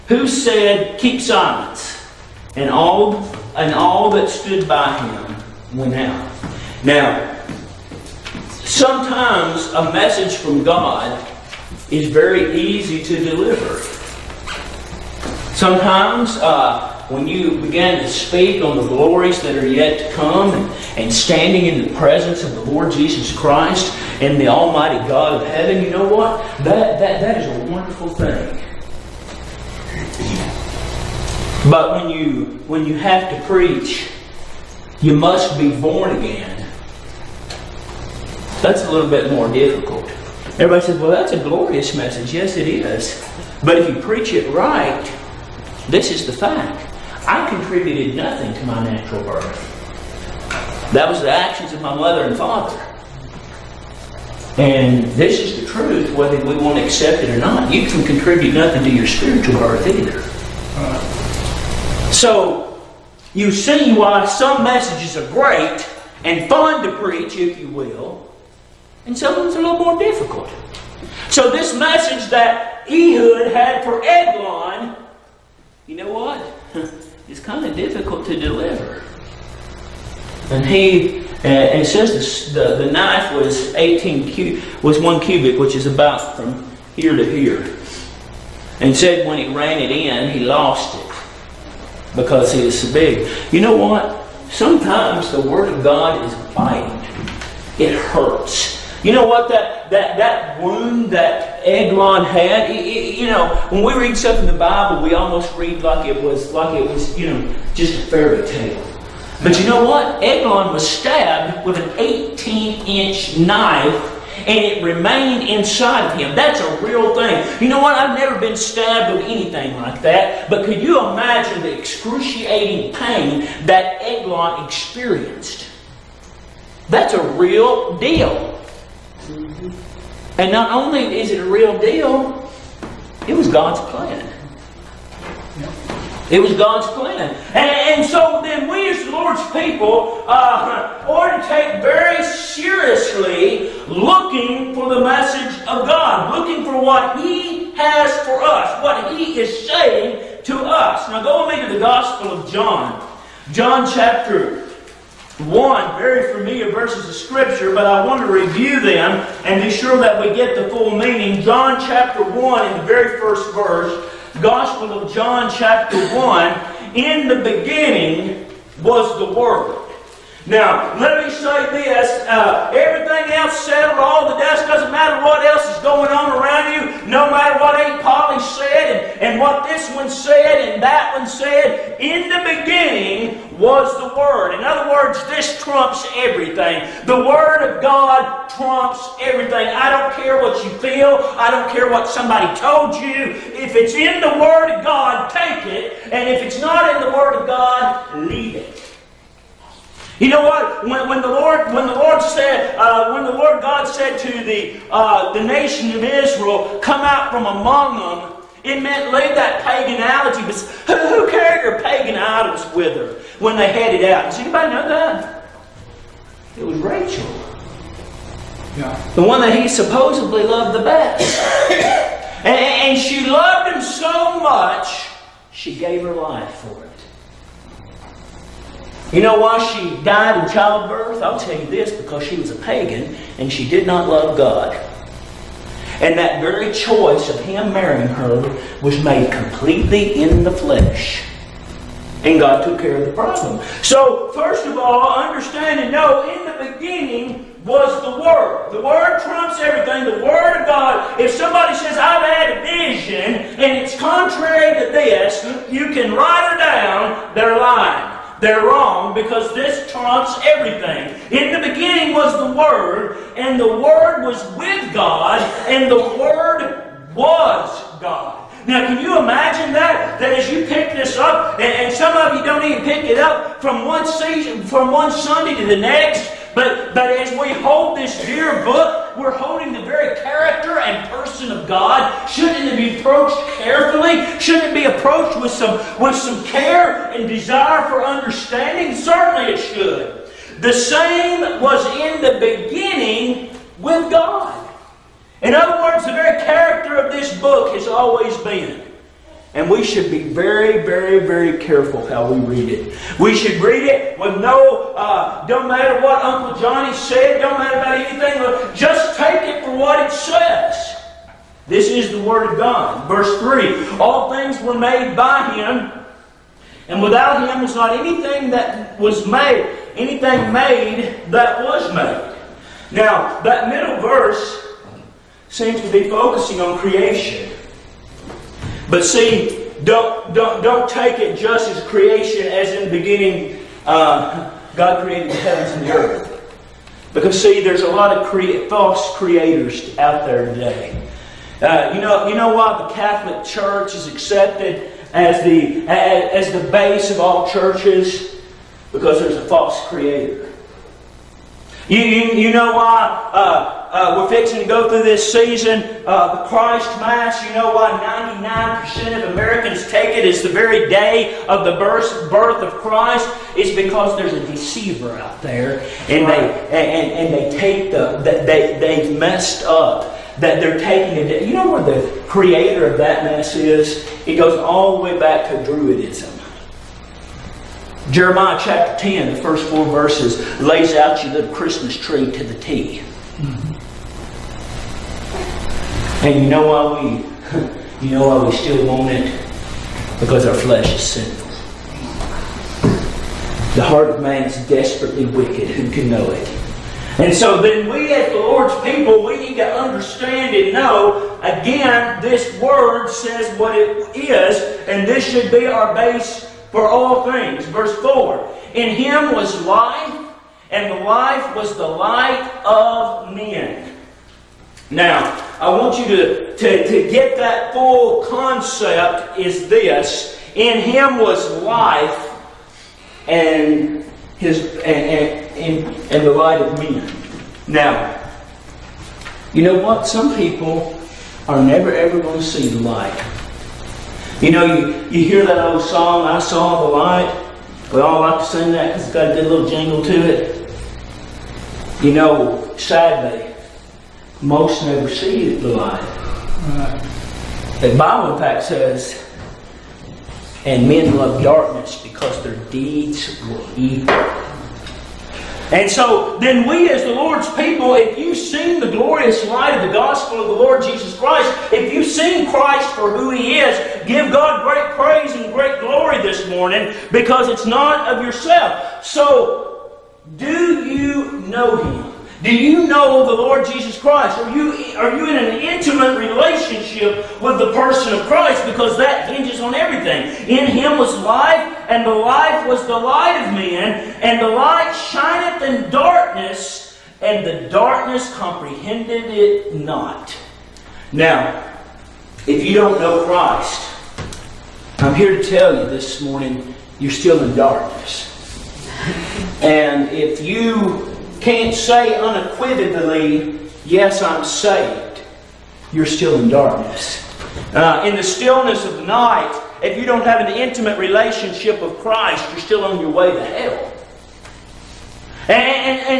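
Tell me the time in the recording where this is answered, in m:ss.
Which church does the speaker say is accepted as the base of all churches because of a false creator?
5:42.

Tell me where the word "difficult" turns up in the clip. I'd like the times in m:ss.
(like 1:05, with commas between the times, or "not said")
0:39, 1:09, 1:17.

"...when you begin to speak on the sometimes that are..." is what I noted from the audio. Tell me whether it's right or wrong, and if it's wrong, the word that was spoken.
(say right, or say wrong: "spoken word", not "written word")
wrong: "glories", not "sometimes".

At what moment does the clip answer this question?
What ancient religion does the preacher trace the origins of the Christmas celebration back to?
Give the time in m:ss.
6:15.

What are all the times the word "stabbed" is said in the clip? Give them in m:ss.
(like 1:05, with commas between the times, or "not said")
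1:50, 1:58.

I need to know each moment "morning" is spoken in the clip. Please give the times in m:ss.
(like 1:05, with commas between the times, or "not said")
7:46, 8:16.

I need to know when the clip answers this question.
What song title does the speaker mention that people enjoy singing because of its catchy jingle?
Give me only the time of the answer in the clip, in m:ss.
7:16.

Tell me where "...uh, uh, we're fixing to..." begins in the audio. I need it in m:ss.
5:53.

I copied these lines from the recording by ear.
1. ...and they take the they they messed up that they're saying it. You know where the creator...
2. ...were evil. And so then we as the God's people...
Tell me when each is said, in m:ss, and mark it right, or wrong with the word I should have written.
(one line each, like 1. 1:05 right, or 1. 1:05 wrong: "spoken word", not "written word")
1. 6:07 wrong: "taking", not "saying"
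2. 7:33 wrong: "Lord", not "God".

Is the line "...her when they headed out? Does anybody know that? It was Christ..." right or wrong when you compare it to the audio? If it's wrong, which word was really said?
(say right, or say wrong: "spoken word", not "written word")
wrong: "Rachel", not "Christ".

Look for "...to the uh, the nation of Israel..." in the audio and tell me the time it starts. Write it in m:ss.
3:24.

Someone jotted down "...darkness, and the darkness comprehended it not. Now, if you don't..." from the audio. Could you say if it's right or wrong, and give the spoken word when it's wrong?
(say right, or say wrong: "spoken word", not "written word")
right.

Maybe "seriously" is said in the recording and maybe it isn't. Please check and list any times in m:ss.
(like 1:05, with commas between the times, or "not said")
2:22.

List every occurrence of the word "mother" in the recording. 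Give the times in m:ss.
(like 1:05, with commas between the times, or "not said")
0:51.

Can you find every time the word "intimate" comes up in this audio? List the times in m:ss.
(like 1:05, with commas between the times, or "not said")
7:55, 8:30.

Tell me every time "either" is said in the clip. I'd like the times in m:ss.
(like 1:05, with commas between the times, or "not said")
0:59.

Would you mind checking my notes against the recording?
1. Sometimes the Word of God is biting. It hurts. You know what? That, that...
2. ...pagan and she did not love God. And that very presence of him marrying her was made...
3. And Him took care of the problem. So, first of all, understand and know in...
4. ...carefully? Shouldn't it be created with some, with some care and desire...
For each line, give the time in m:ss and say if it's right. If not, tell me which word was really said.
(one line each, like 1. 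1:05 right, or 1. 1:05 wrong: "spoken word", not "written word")
1. 1:34 right
2. 3:52 wrong: "choice", not "presence"
3. 4:02 wrong: "God", not "Him"
4. 4:43 wrong: "approached", not "created".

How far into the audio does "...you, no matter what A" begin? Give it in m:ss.
2:56.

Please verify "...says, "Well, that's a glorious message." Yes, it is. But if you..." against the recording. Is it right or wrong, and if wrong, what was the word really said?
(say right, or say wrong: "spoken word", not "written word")
right.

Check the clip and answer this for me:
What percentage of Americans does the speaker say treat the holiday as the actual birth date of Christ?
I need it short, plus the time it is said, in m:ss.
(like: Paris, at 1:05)
99%, at 5:58.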